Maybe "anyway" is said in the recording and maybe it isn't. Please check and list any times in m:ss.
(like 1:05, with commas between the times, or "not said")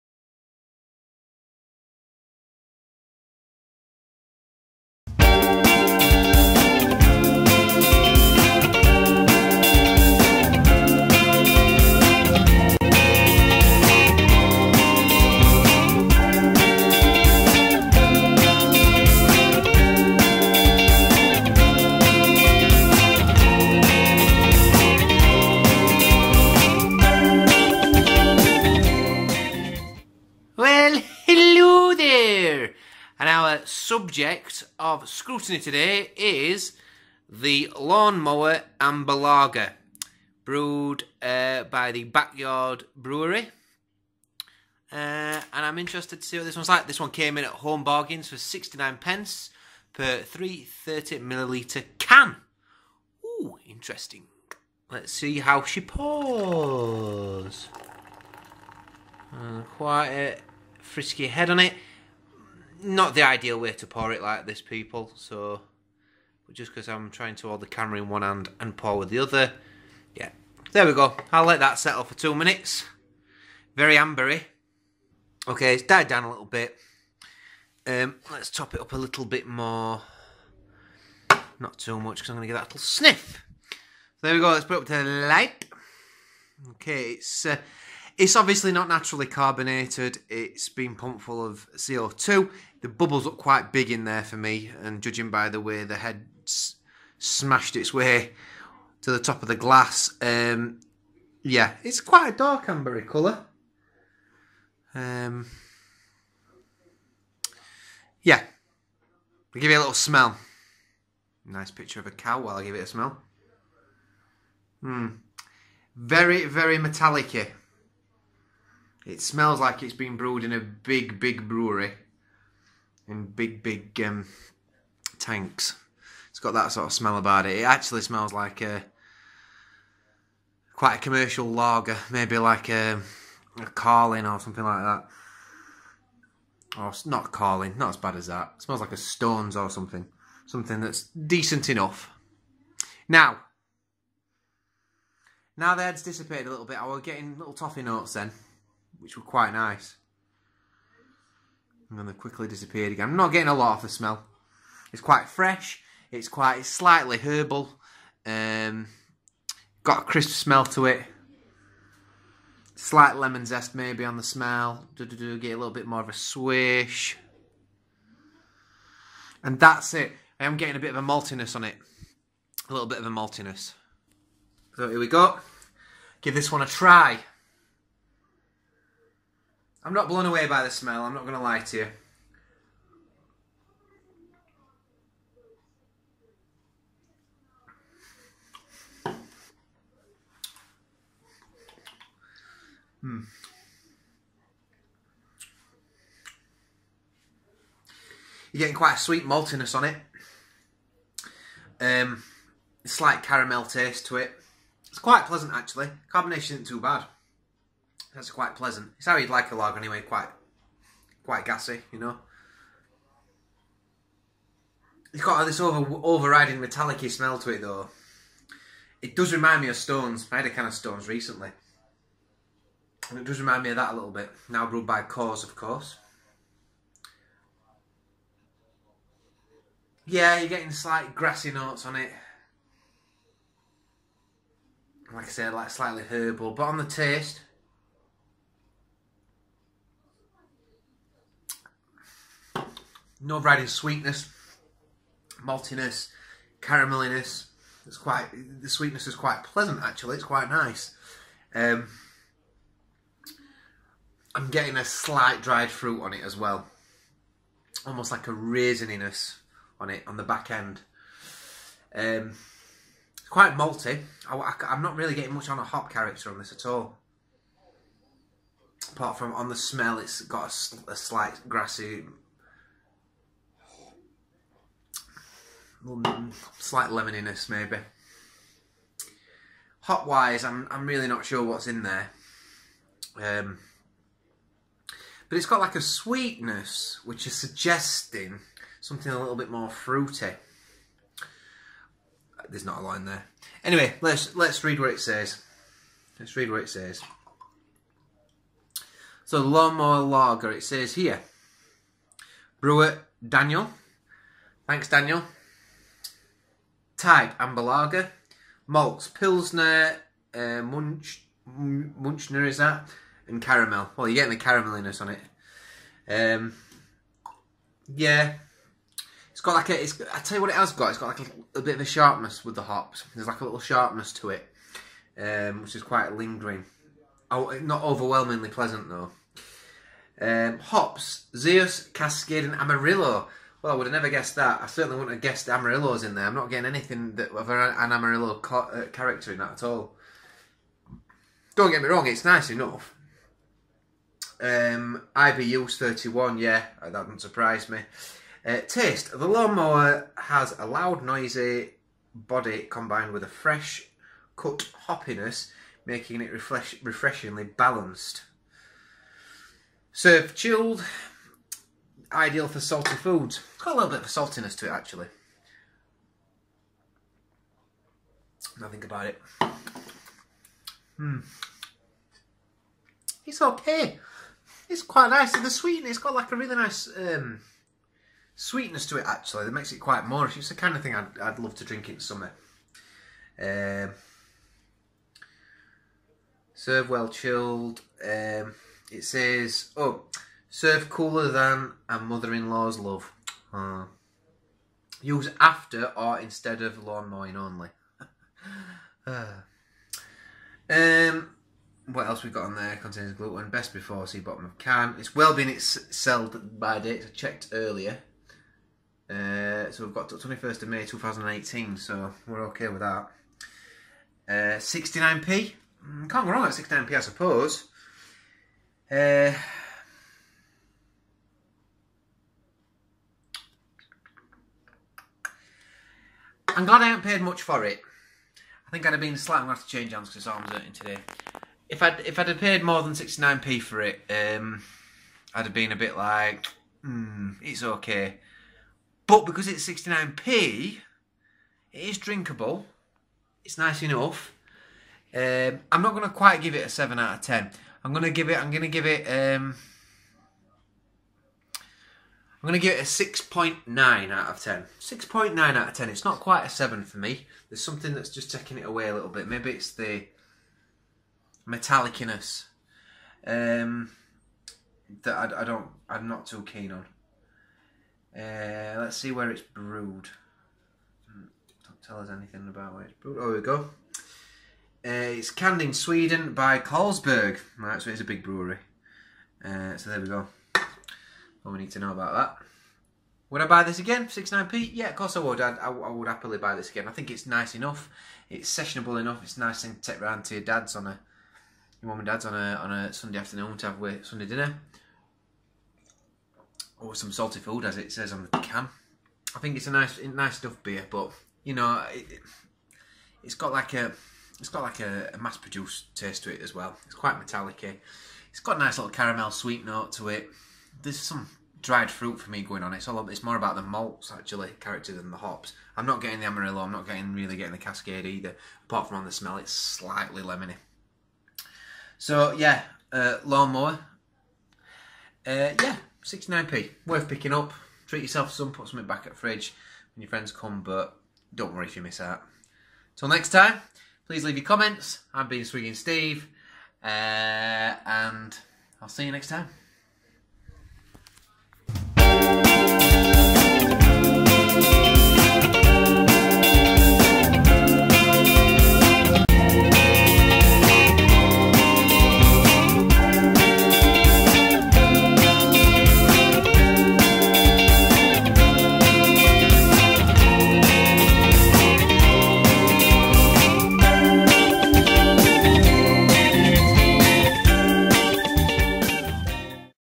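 3:29, 4:53.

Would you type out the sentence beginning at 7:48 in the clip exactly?
Uh, let's see where it's brewed.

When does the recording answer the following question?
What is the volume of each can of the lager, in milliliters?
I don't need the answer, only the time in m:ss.
0:50.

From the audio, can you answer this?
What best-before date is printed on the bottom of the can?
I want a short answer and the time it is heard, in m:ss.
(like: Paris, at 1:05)
21 May 2018, at 6:50.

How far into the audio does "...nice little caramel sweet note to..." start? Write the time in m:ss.
8:28.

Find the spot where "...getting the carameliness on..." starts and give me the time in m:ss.
5:14.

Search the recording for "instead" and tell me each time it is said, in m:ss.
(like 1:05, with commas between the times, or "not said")
6:36.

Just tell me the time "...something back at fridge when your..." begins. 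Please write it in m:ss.
8:48.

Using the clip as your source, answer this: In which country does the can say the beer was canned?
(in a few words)
Sweden.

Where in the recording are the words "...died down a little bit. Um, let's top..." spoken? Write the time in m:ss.
1:15.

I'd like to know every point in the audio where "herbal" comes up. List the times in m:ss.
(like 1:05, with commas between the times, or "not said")
2:37, 3:56.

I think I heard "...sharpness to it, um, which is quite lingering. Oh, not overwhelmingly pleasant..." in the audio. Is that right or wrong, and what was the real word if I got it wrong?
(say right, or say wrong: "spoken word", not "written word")
right.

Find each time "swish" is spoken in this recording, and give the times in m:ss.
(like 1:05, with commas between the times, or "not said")
2:46.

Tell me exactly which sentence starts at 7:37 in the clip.
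There's something that's just taking it away a little bit.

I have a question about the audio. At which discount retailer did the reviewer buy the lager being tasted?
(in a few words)
Home Bargains.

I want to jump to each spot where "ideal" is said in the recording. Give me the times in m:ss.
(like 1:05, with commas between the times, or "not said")
1:03, 6:02.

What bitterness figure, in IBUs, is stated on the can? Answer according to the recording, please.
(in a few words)
31.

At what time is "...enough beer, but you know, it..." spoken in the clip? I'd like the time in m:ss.
8:20.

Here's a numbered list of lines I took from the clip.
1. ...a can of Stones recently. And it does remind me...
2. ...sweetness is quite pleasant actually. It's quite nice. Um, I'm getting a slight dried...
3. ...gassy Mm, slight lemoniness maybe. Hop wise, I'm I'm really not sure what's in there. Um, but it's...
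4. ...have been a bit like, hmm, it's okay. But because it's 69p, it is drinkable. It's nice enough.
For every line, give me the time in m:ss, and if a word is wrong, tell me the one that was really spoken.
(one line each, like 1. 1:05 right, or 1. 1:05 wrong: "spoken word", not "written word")
1. 3:40 right
2. 4:08 right
3. 4:31 wrong: "grassy", not "gassy"
4. 7:15 right.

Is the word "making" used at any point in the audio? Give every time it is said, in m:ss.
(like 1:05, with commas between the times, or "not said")
5:55.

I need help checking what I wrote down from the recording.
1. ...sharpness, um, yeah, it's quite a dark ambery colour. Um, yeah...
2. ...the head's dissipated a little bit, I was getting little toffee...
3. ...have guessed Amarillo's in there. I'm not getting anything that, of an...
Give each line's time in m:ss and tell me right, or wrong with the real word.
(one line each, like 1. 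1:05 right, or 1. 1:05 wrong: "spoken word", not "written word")
1. 1:39 wrong: "glass", not "sharpness"
2. 2:25 right
3. 5:35 right.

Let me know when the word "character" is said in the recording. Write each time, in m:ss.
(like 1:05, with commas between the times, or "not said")
4:25, 5:38, 8:34.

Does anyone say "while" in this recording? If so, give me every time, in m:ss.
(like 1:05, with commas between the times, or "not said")
1:52.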